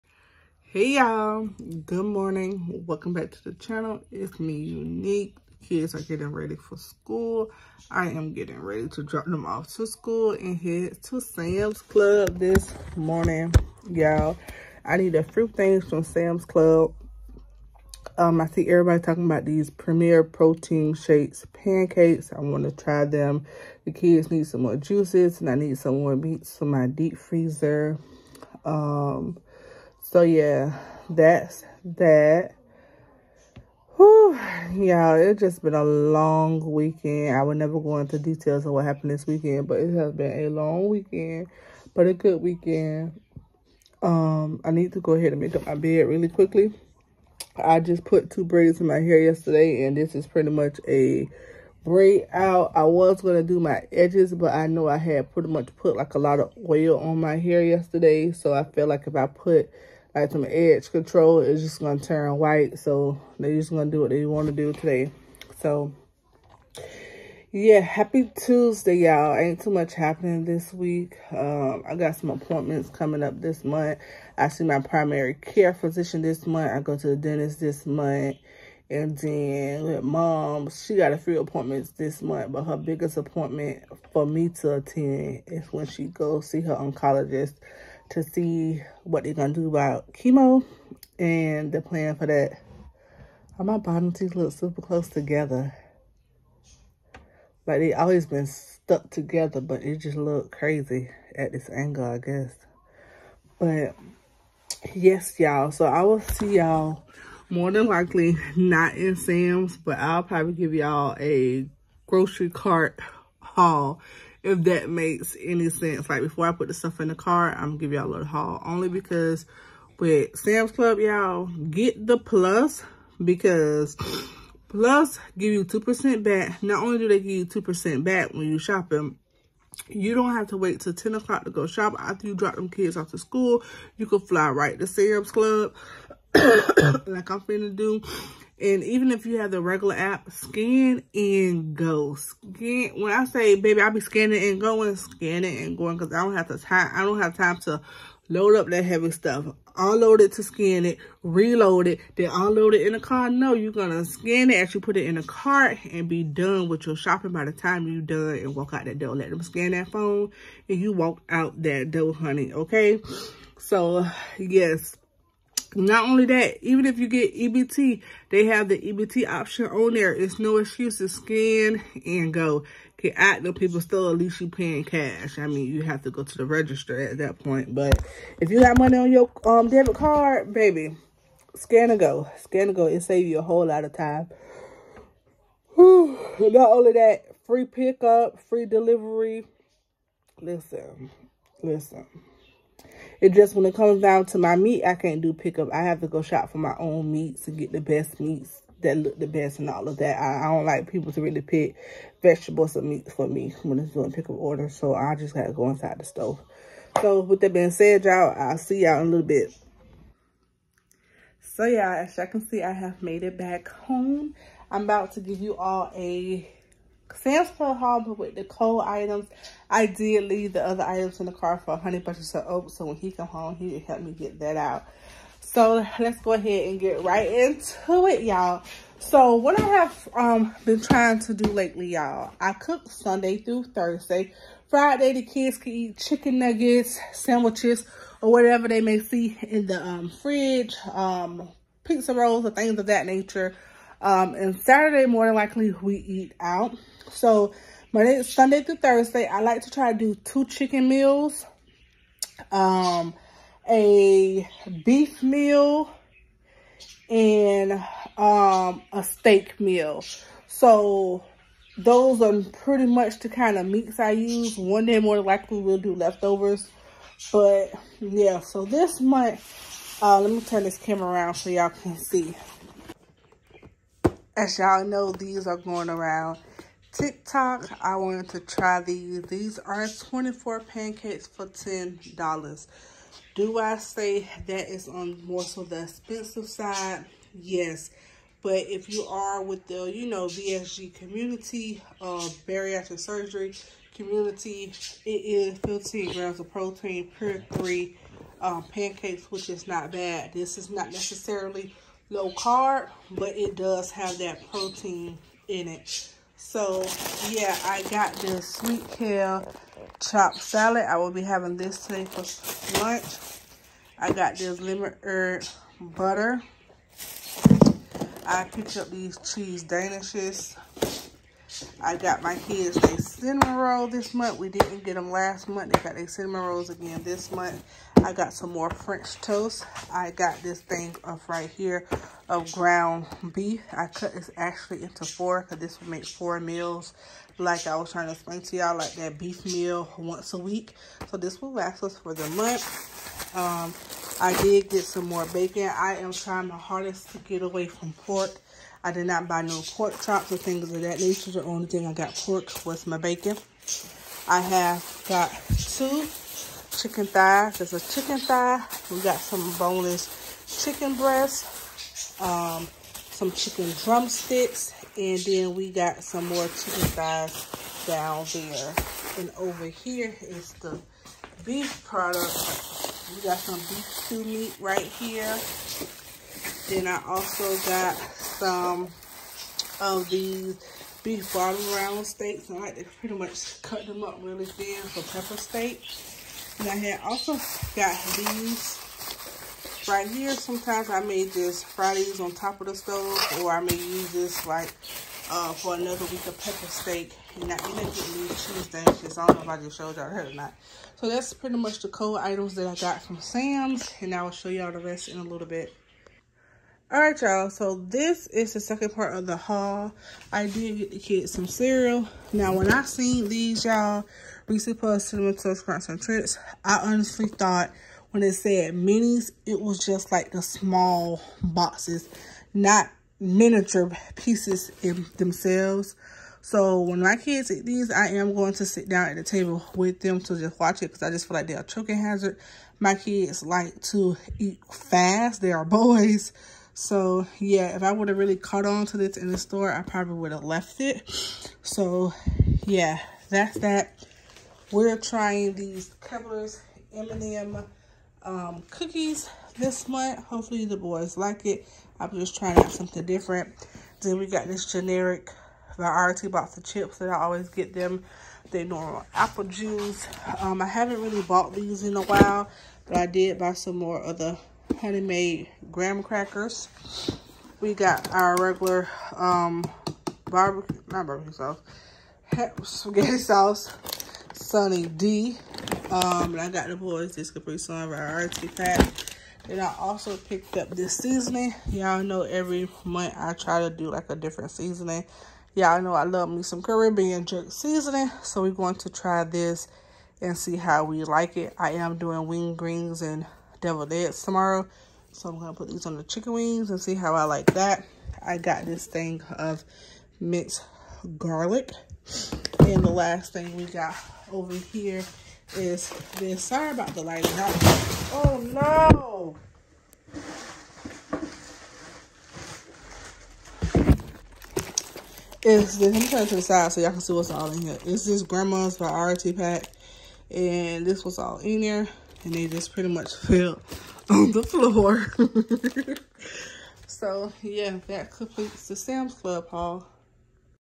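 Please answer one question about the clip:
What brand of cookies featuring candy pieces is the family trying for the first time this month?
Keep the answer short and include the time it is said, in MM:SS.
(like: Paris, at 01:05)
Keebler, at 07:26.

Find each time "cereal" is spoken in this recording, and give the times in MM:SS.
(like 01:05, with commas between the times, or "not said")
06:51.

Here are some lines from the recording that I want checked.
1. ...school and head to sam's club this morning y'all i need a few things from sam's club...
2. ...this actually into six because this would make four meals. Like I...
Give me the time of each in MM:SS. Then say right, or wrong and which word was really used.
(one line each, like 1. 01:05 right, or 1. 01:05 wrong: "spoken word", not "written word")
1. 00:09 right
2. 05:34 wrong: "four", not "six".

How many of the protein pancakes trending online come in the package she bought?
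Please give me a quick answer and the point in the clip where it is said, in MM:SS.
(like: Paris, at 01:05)
24, at 04:39.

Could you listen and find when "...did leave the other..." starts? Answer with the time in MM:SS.
03:39.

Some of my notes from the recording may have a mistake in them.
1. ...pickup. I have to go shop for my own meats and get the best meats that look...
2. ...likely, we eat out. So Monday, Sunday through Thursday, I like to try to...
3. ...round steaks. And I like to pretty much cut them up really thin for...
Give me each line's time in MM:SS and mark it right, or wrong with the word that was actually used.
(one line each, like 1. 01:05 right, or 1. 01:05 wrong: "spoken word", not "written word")
1. 03:15 right
2. 04:05 right
3. 06:21 right.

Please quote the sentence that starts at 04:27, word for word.
But yeah, so this month, uh, let me turn this camera around so y'all can see.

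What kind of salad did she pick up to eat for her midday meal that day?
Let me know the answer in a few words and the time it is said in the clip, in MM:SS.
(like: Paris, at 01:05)
sweet kale chopped salad, at 05:08.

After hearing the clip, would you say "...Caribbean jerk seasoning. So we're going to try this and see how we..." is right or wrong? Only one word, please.
right.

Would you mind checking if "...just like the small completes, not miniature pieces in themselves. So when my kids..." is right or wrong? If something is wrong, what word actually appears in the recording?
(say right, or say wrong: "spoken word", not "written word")
wrong: "boxes", not "completes".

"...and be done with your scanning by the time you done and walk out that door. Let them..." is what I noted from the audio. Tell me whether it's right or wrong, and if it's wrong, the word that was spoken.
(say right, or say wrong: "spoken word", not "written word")
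wrong: "shopping", not "scanning".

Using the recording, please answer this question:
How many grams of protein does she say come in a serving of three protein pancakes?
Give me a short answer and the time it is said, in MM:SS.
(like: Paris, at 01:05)
15 grams, at 04:55.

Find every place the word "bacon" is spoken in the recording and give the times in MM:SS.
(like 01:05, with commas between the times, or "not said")
05:45, 05:52.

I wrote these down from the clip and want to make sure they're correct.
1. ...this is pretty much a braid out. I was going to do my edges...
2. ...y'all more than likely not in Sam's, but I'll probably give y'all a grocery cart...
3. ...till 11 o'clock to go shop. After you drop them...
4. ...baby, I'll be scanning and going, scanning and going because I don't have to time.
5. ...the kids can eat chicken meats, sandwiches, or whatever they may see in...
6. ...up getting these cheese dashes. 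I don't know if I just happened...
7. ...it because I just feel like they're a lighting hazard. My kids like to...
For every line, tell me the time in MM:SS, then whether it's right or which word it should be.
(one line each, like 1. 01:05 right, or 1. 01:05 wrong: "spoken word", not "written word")
1. 00:49 right
2. 01:46 right
3. 02:10 wrong: "10", not "11"
4. 02:23 right
5. 03:55 wrong: "nuggets", not "meats"
6. 06:37 wrong: "showed", not "happened"
7. 07:10 wrong: "choking", not "lighting".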